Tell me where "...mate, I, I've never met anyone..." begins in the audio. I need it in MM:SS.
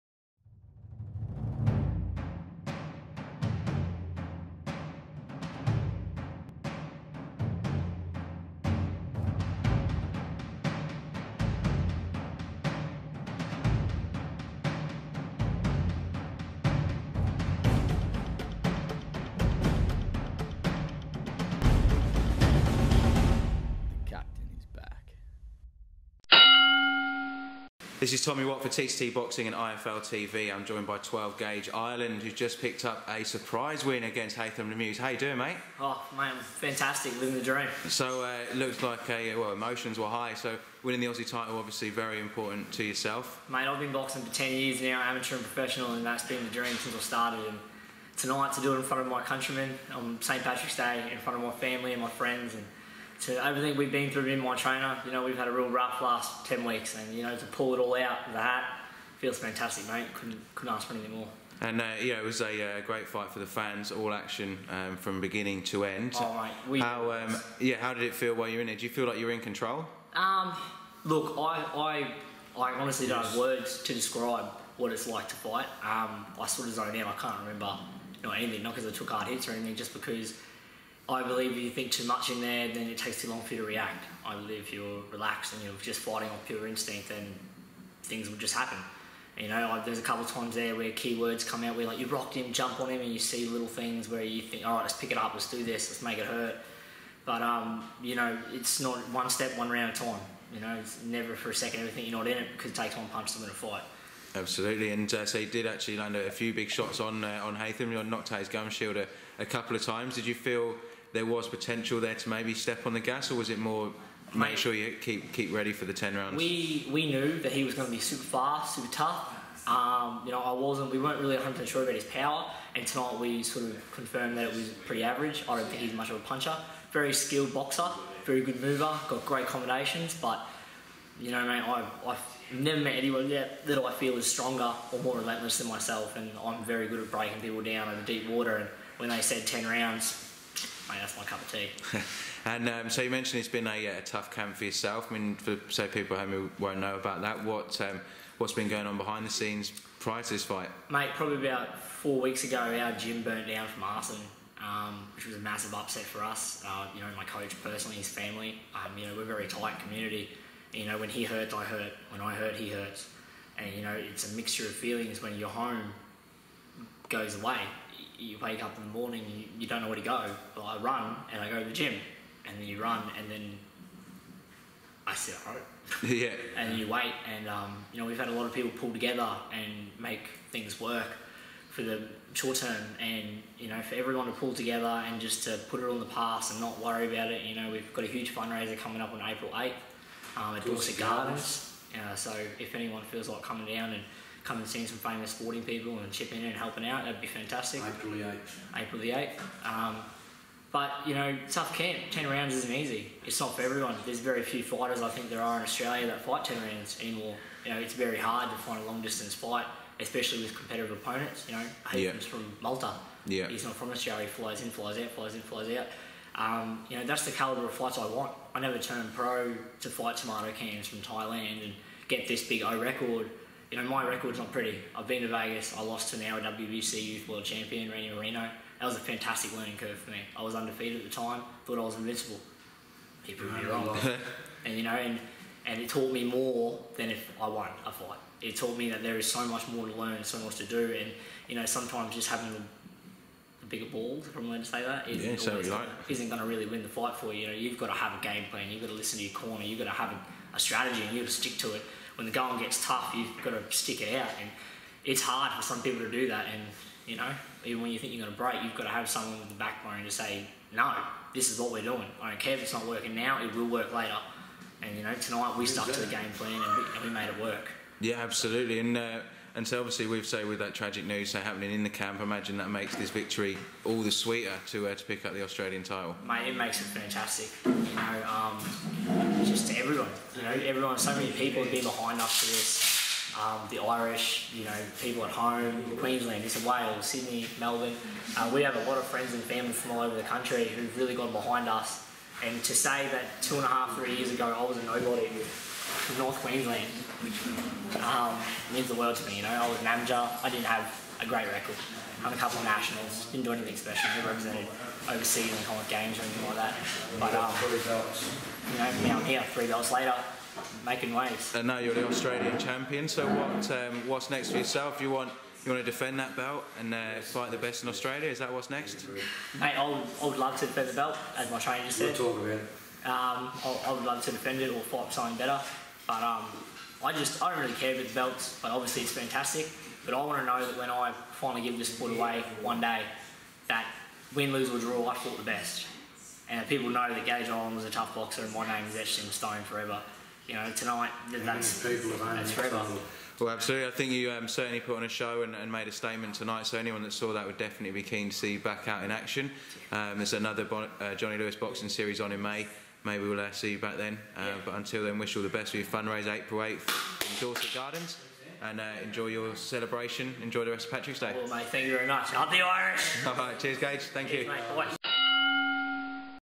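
02:11.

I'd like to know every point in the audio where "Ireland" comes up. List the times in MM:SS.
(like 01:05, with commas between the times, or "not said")
00:31, 05:37.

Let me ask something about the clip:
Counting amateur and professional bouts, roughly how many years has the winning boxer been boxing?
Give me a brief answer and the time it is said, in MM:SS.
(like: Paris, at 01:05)
10 years, at 00:44.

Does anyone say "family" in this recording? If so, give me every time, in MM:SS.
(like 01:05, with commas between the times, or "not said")
00:51, 02:38, 04:49.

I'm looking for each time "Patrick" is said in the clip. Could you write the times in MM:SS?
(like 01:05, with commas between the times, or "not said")
00:50, 06:00.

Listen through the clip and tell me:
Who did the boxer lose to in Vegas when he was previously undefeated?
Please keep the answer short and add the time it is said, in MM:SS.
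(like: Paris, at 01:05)
Randy Marino, at 03:47.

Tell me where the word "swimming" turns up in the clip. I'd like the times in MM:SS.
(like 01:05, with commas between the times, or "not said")
not said.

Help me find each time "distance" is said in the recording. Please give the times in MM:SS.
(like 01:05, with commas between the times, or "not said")
03:29.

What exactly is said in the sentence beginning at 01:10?
Um, look, I, I, I honestly don't have words to describe what it's like to fight.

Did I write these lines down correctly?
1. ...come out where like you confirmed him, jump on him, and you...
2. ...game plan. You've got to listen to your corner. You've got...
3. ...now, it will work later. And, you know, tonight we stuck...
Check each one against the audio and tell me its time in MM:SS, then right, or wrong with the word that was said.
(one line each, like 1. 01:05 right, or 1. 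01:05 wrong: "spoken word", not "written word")
1. 01:31 wrong: "rocked", not "confirmed"
2. 04:08 right
3. 04:23 right.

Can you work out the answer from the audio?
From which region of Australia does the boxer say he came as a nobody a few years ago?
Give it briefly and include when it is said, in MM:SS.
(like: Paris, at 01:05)
North Queensland, at 04:56.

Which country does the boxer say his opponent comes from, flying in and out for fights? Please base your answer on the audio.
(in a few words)
Malta.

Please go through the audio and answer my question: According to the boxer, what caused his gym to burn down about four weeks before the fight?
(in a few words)
Arson.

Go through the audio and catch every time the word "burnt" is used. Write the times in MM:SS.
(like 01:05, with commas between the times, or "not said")
02:33.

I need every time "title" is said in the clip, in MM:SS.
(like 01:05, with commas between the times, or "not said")
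00:41, 04:35.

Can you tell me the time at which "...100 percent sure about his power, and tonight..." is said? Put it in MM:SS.
02:01.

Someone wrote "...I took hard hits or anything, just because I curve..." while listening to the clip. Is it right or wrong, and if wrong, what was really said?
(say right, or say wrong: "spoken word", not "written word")
wrong: "believe", not "curve".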